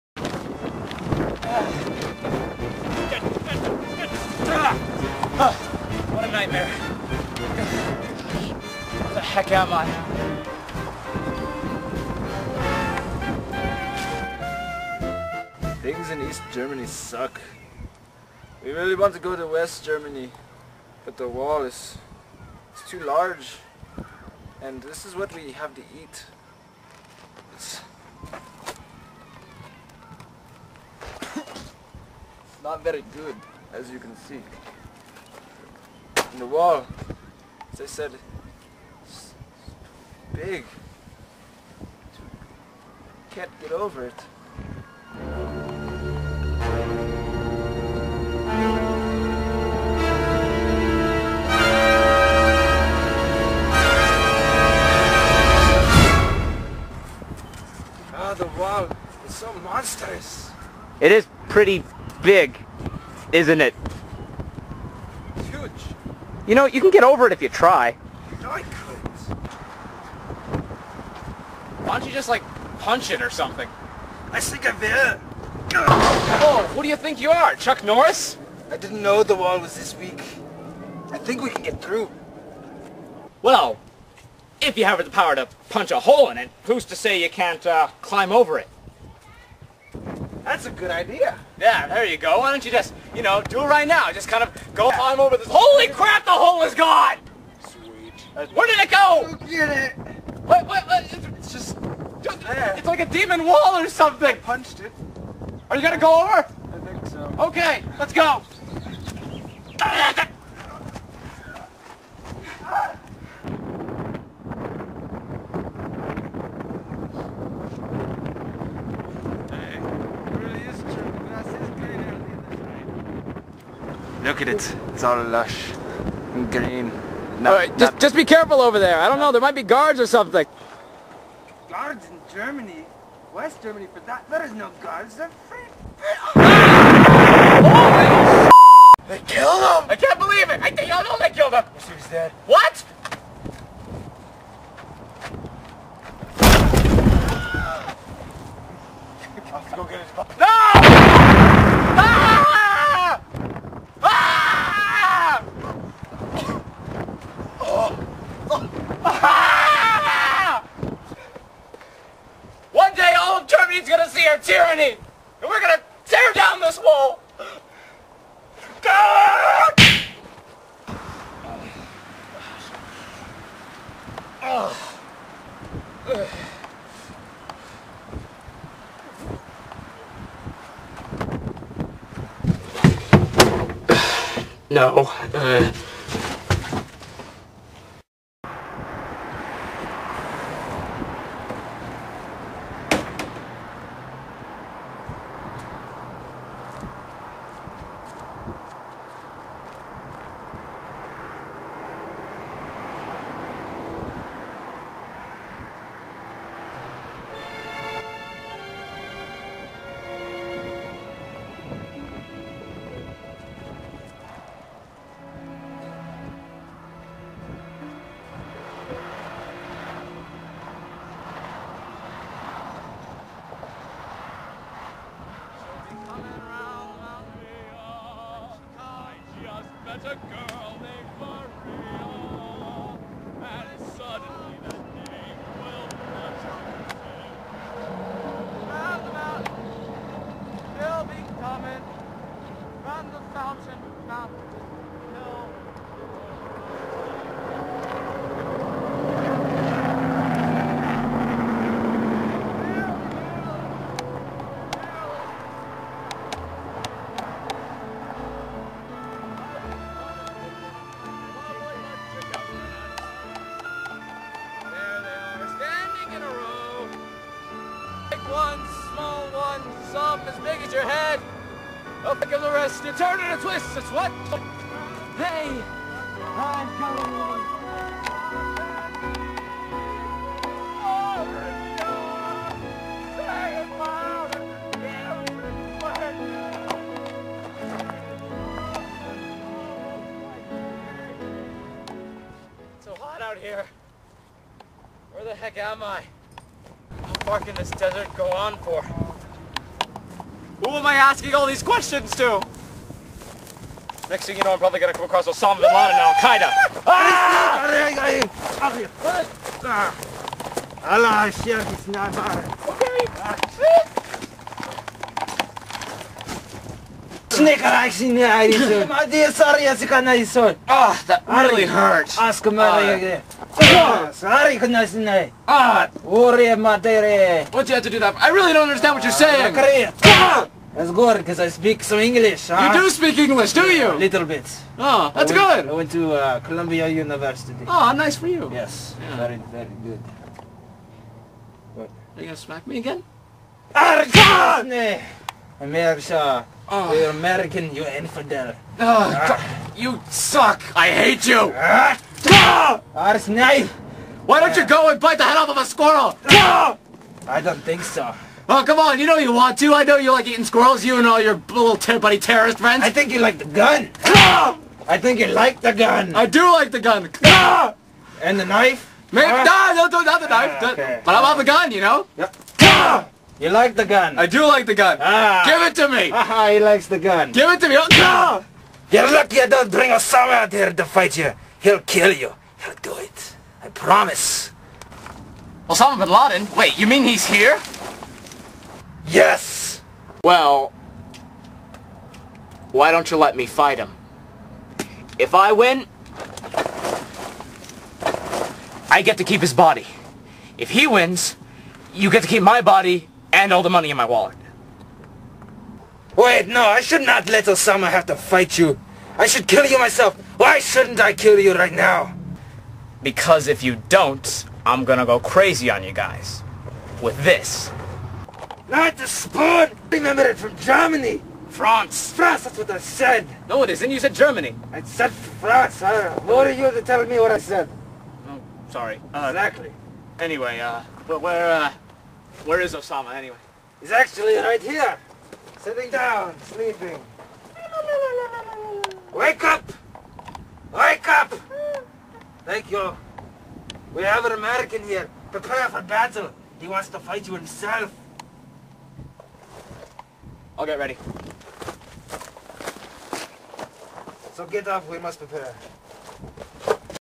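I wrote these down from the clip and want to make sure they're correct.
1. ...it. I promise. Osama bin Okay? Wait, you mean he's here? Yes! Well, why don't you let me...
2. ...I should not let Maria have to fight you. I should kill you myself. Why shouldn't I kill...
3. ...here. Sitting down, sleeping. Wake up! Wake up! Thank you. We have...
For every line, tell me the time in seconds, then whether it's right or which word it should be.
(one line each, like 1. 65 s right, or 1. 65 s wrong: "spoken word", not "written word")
1. 382 s wrong: "Laden", not "Okay"
2. 406 s wrong: "Osama", not "Maria"
3. 434 s right.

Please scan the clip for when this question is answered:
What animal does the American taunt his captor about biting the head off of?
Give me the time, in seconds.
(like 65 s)
355 s.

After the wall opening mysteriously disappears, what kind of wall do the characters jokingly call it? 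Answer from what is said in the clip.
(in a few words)
demon wall.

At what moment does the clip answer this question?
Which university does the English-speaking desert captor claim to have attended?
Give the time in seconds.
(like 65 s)
336 s.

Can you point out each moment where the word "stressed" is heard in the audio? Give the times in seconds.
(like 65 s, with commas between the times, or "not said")
not said.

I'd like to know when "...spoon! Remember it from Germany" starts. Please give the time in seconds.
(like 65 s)
419 s.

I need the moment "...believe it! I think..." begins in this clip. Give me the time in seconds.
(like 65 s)
140 s.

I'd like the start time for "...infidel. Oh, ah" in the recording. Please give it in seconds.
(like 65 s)
347 s.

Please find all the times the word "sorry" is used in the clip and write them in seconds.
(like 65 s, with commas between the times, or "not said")
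324 s, 428 s.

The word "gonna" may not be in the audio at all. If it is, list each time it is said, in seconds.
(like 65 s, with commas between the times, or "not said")
105 s, 304 s, 414 s.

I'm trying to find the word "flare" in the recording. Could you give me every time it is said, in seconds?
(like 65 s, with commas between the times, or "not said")
not said.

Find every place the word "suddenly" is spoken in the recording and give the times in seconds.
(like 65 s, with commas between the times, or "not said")
233 s.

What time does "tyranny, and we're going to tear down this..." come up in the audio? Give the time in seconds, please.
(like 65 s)
164 s.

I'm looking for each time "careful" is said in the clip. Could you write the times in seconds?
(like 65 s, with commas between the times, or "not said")
128 s.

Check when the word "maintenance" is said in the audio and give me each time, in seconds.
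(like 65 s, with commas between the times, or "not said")
not said.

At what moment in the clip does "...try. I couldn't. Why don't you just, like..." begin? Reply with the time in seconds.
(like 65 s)
67 s.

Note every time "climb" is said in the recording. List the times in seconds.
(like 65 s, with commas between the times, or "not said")
88 s, 94 s.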